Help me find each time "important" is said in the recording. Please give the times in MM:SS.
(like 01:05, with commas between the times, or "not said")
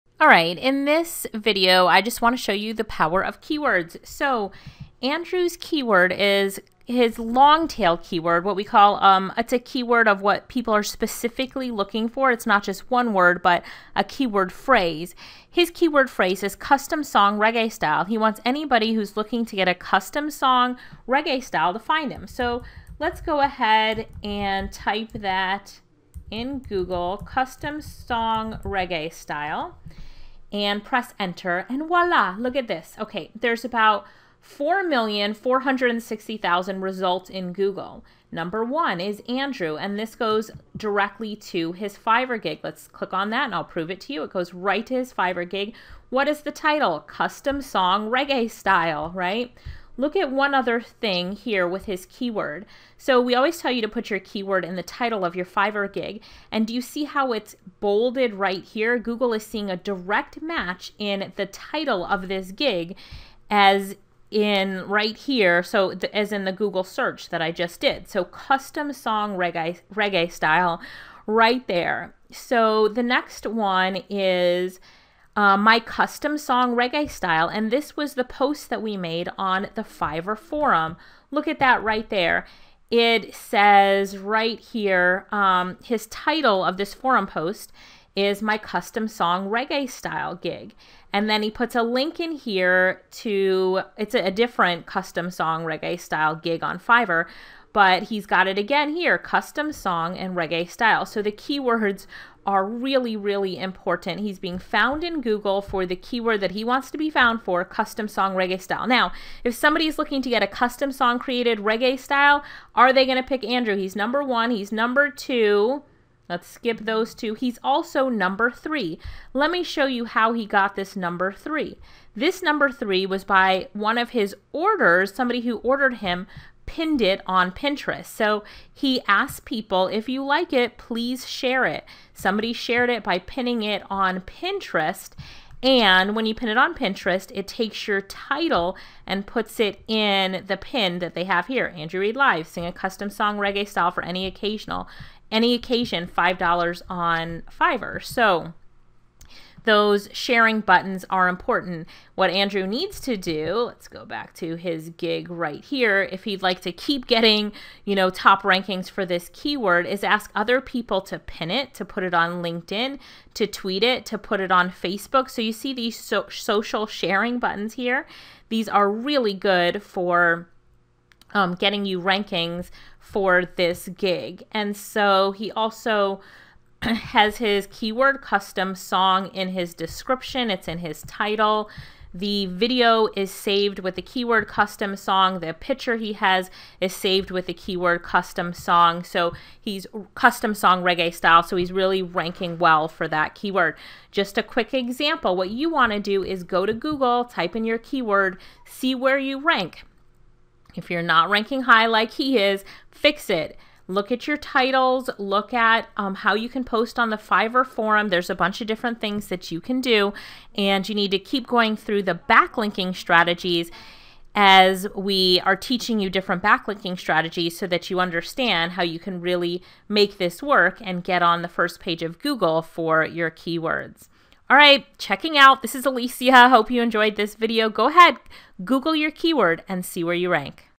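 01:43, 02:31.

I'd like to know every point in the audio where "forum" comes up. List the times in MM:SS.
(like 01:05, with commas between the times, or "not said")
01:20, 01:26, 03:27.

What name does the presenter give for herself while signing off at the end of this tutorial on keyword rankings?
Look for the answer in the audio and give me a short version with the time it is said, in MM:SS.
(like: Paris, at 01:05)
Alicia, at 03:45.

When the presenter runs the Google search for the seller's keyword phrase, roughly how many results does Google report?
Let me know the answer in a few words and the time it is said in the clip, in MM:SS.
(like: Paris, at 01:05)
4,460,000, at 00:34.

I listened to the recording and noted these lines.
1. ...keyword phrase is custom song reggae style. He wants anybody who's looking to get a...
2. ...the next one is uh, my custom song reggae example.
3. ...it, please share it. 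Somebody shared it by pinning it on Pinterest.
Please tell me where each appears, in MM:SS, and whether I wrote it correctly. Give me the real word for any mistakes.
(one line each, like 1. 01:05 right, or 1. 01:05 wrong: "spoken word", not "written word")
1. 00:15 right
2. 01:12 wrong: "style", not "example"
3. 02:10 right.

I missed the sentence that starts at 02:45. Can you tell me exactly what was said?
So you see these so social sharing buttons here.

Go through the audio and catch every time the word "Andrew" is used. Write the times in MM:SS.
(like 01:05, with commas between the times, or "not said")
00:05, 00:39, 01:53, 02:21, 02:32.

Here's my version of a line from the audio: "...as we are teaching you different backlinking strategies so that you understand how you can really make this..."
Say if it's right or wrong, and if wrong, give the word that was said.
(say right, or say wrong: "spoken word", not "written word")
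right.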